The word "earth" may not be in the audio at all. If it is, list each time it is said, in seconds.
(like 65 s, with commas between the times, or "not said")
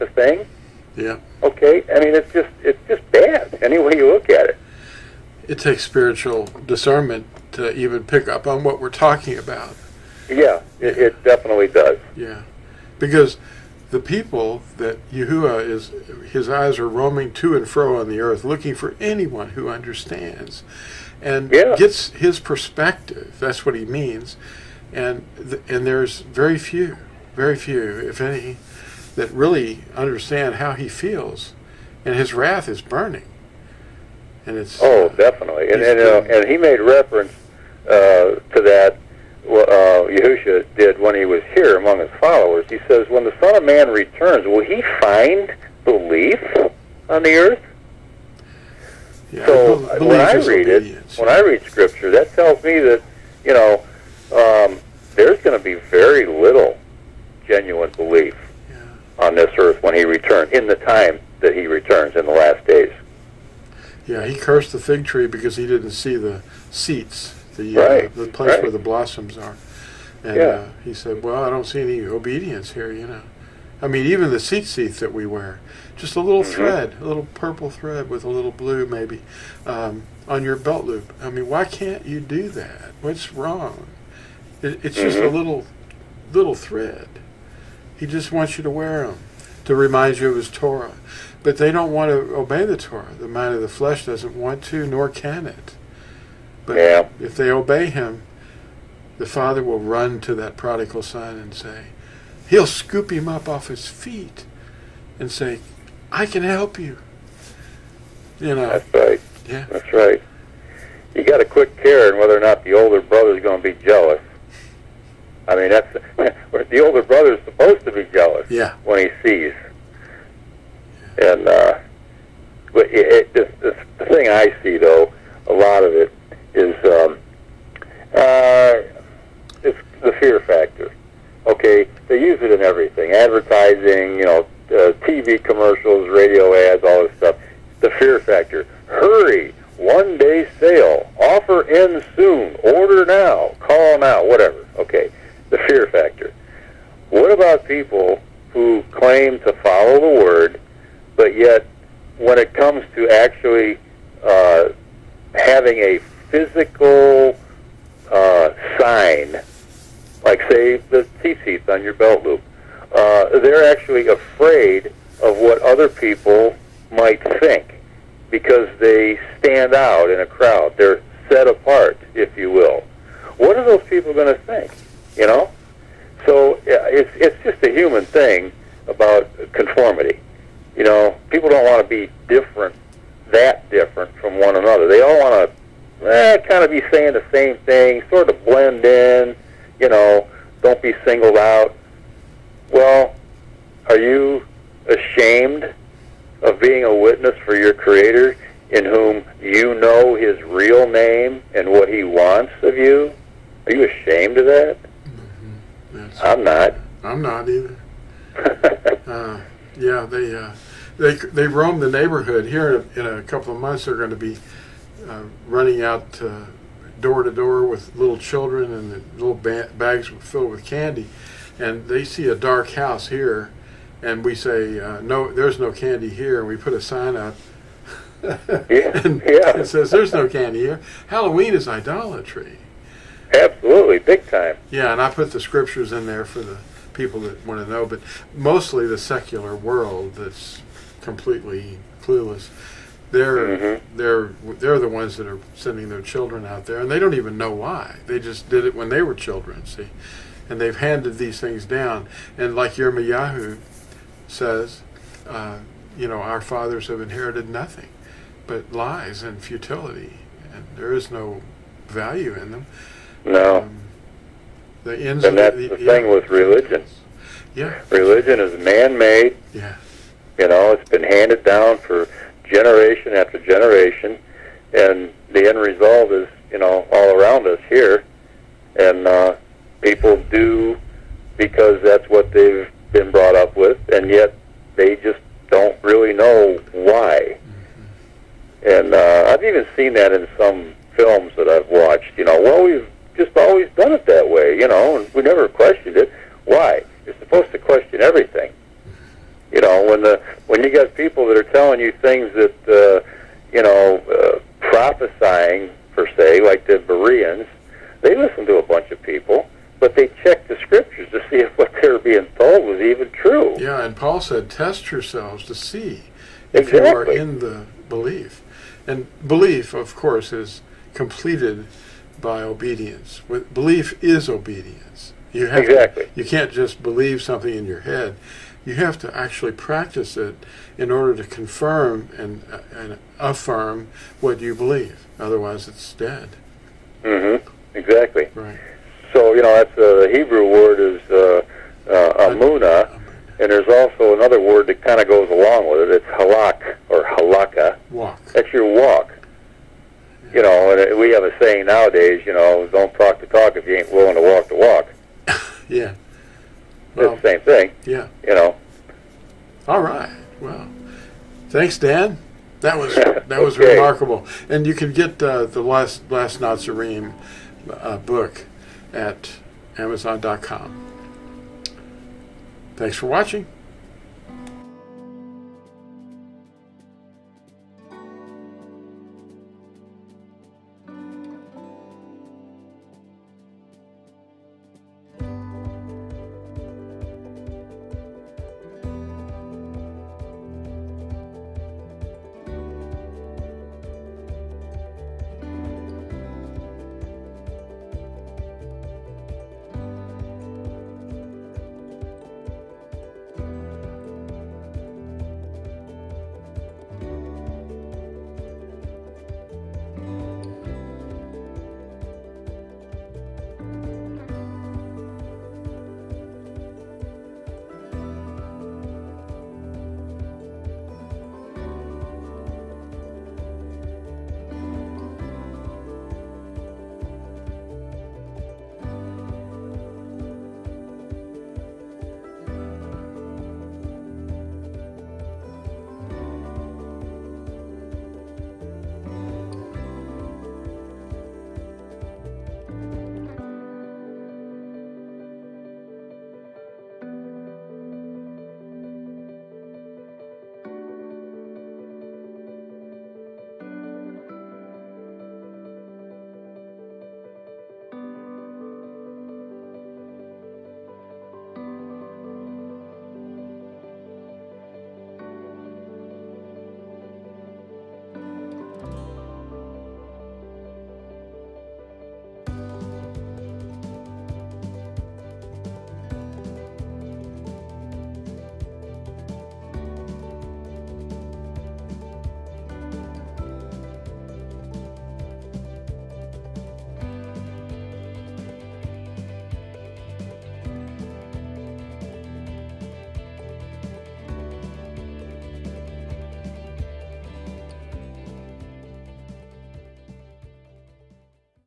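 18 s, 47 s, 59 s.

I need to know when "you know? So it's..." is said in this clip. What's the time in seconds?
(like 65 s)
175 s.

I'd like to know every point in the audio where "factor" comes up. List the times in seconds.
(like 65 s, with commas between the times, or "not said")
130 s, 138 s, 145 s.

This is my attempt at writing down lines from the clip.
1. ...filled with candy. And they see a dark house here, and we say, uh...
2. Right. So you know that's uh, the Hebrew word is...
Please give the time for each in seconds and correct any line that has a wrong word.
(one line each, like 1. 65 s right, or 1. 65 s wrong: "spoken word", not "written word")
1. 220 s right
2. 338 s right.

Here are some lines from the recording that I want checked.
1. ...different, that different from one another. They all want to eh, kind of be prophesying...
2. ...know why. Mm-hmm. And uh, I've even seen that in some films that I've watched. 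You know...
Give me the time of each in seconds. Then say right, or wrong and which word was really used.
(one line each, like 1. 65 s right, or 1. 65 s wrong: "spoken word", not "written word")
1. 182 s wrong: "saying", not "prophesying"
2. 286 s right.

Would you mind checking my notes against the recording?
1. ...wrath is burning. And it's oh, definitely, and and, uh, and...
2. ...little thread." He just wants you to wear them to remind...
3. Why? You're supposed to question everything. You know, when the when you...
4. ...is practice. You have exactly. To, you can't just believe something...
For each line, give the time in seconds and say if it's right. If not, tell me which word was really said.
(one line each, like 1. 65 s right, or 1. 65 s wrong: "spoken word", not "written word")
1. 32 s right
2. 86 s right
3. 296 s right
4. 324 s wrong: "obedience", not "practice".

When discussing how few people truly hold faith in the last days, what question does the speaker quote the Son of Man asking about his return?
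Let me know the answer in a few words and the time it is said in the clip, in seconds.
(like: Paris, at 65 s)
Will he find belief, at 44 s.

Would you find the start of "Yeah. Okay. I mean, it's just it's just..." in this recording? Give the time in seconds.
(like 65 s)
0 s.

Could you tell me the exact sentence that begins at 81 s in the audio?
I mean, why can't you do that?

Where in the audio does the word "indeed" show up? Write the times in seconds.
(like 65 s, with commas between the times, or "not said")
not said.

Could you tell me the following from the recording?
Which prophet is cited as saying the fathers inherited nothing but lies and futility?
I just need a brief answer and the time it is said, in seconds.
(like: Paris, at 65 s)
Yirmiyahu, at 252 s.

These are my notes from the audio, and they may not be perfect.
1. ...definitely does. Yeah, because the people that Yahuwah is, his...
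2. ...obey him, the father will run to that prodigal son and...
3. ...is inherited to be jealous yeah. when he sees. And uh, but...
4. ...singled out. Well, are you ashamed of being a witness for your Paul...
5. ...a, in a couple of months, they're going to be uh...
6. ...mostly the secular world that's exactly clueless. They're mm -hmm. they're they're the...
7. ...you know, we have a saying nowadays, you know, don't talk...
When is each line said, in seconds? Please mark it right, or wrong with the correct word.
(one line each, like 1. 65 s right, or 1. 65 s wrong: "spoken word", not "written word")
1. 11 s right
2. 97 s right
3. 117 s wrong: "supposed", not "inherited"
4. 191 s wrong: "Creator", not "Paul"
5. 213 s right
6. 238 s wrong: "completely", not "exactly"
7. 350 s right.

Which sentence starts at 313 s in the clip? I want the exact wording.
Yeah, and Paul said, "Test yourselves to see if exactly.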